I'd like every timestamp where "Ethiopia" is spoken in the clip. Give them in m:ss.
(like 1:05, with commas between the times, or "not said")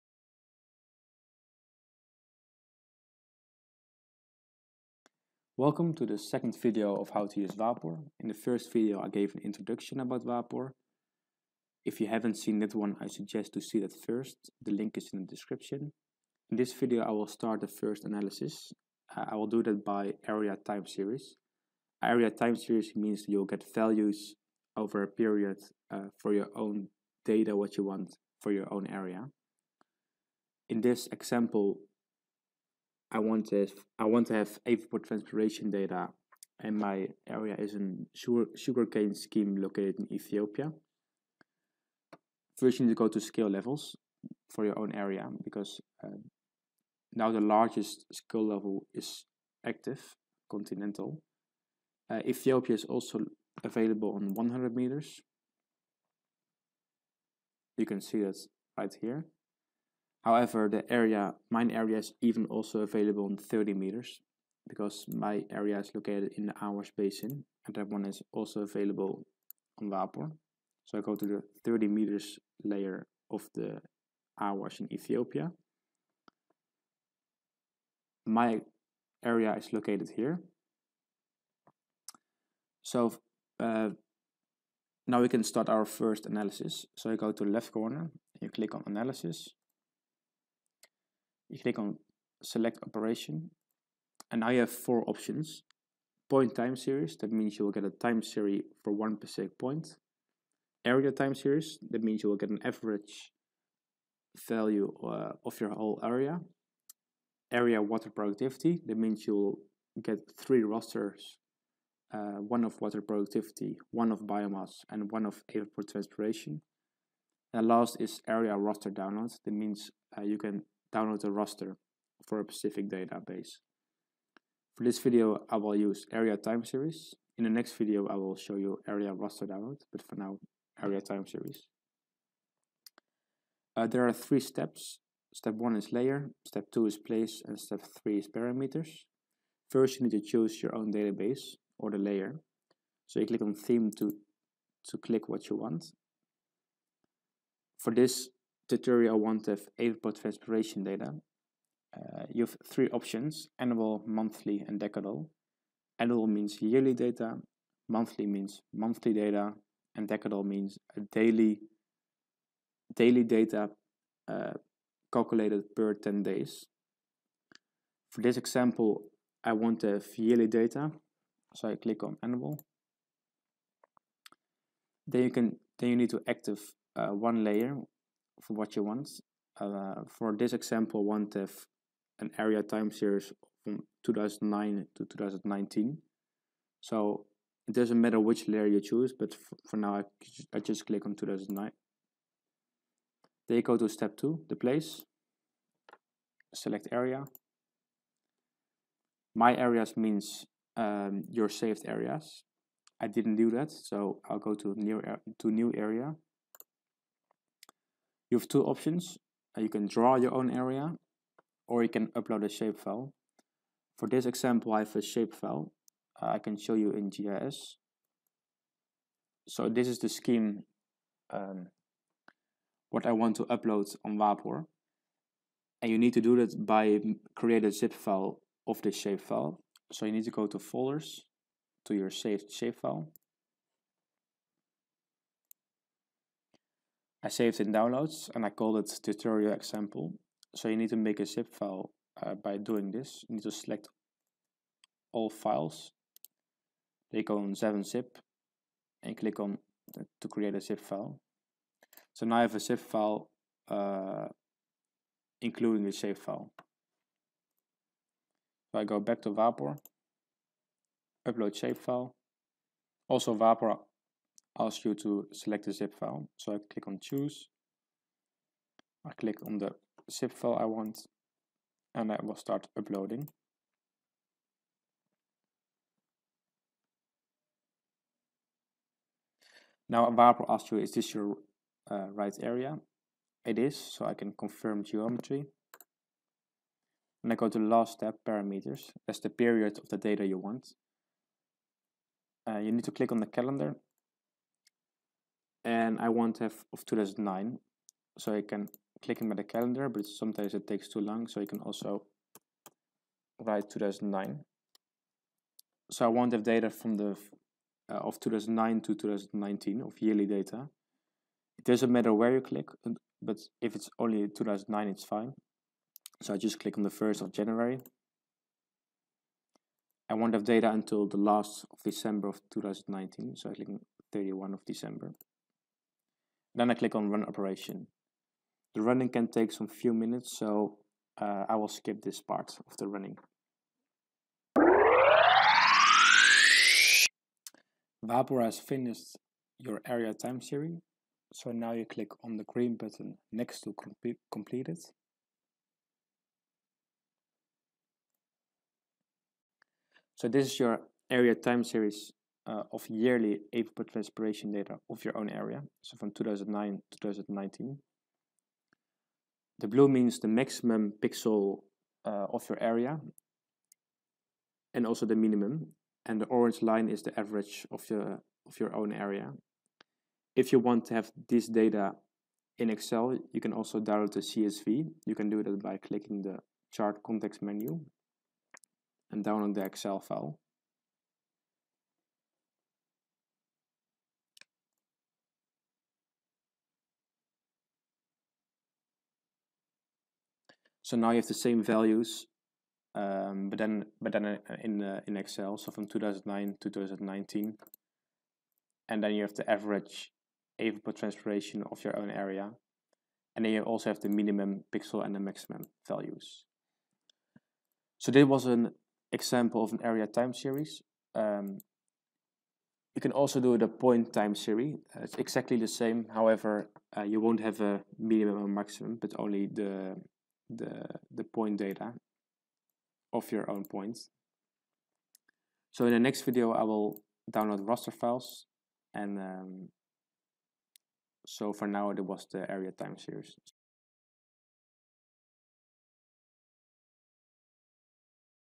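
0:40, 0:52, 1:14.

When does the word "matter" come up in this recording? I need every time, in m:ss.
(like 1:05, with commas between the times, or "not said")
3:08, 5:11.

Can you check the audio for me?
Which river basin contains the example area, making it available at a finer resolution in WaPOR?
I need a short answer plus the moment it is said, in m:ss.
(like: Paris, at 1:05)
Awash Basin, at 1:06.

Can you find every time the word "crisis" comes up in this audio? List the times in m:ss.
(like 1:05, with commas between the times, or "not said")
not said.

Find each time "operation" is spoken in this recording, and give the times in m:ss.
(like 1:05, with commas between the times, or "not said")
1:32, 5:27.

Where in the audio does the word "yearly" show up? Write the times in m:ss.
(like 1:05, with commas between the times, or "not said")
2:36, 2:50, 5:09, 5:52.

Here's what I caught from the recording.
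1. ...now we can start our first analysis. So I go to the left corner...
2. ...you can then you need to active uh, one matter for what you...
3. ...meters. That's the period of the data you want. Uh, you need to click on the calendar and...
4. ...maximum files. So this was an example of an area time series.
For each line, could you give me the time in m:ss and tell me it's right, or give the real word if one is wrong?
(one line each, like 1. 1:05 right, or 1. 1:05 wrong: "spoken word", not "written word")
1. 1:25 right
2. 2:55 wrong: "layer", not "matter"
3. 4:48 wrong: "parameters", not "meters"
4. 6:45 wrong: "values", not "files".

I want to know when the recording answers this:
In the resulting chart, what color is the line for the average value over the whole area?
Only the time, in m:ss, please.
6:06.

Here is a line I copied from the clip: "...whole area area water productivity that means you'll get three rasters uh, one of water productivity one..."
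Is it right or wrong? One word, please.
right.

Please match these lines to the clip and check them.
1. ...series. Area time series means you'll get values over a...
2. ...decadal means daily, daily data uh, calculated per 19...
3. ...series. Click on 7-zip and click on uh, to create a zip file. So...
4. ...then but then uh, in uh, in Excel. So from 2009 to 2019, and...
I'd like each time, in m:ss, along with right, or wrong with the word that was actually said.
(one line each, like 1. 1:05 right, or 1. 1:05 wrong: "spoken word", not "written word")
1. 0:20 right
2. 2:40 wrong: "10", not "19"
3. 4:05 wrong: "files", not "series"
4. 6:33 right.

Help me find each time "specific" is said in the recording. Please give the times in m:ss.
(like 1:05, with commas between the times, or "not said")
1:39, 2:02.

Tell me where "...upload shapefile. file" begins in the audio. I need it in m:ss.
4:21.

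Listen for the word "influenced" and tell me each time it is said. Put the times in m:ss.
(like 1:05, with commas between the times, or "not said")
not said.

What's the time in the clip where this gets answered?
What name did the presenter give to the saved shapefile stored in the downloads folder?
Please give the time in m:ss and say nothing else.
3:59.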